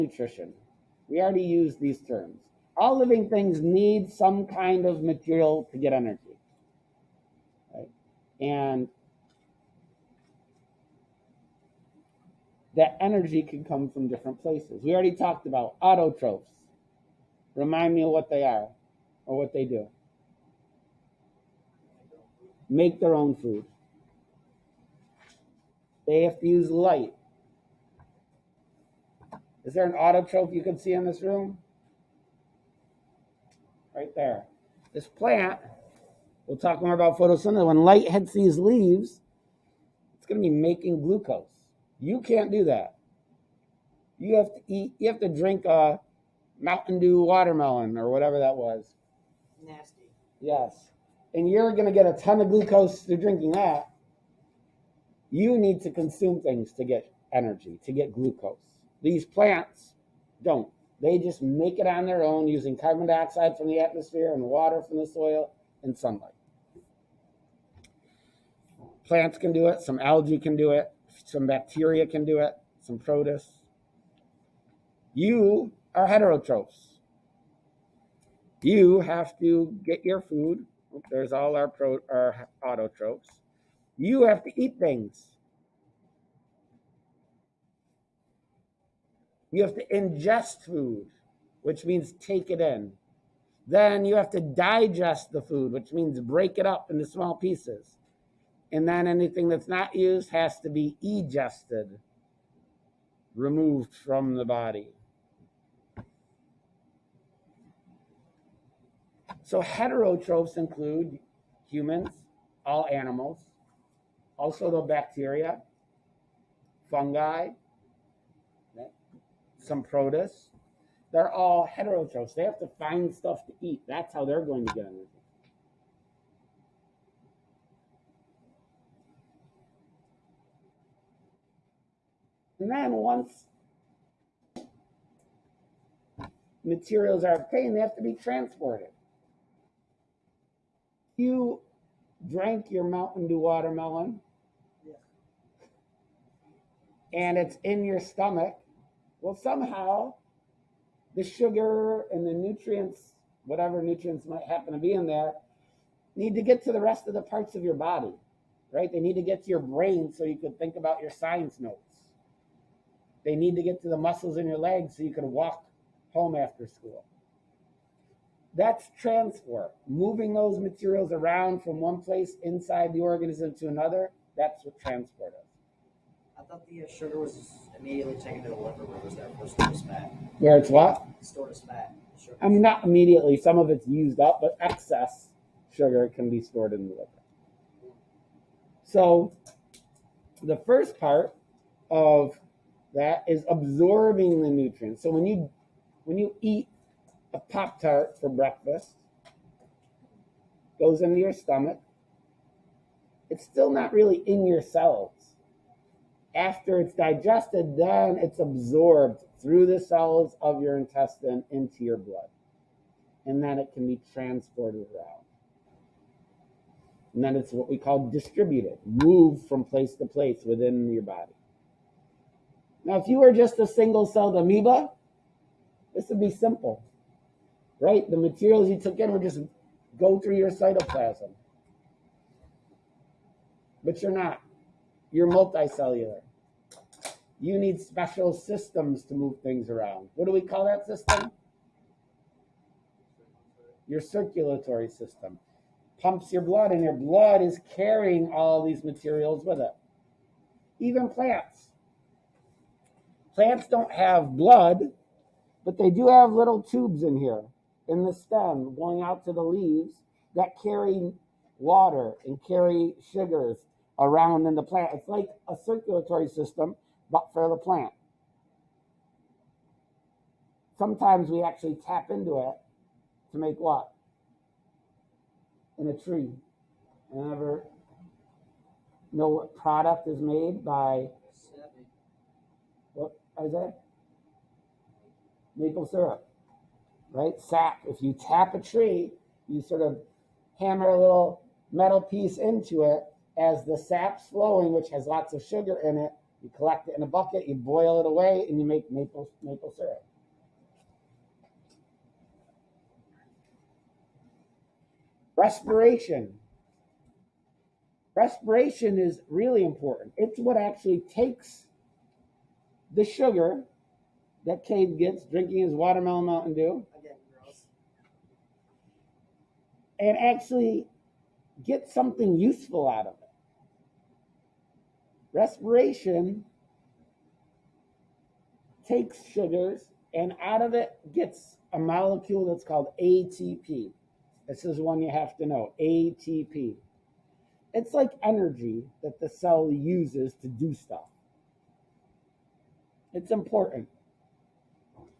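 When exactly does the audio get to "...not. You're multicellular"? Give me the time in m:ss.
3:54.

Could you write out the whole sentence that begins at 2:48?
That's transport, moving those materials around from one place inside the organism to another.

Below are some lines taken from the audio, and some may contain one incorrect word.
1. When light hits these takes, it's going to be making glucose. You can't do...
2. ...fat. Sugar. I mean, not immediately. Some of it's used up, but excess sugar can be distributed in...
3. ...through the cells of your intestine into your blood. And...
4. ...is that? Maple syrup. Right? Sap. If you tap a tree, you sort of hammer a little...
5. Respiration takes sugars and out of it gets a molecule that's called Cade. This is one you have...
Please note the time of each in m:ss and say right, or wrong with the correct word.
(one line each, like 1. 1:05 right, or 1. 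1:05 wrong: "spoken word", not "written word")
1. 0:37 wrong: "leaves", not "takes"
2. 3:01 wrong: "stored", not "distributed"
3. 3:29 right
4. 4:43 right
5. 5:25 wrong: "ATP", not "Cade".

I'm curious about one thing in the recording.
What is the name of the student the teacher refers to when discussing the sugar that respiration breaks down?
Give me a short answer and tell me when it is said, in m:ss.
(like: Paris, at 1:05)
Cade, at 5:14.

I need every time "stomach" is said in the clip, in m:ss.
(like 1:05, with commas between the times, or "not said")
2:28, 3:21.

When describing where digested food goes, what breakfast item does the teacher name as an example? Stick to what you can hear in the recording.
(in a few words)
Pop tart.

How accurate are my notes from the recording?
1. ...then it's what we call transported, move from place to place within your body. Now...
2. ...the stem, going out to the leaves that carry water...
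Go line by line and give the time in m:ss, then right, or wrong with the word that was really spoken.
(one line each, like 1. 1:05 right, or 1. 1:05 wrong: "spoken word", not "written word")
1. 3:37 wrong: "distributed", not "transported"
2. 4:18 right.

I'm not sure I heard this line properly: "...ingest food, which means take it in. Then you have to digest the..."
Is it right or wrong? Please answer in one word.
right.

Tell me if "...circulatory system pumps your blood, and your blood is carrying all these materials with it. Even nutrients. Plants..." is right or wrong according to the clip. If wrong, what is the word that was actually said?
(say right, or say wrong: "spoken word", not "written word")
wrong: "plants", not "nutrients".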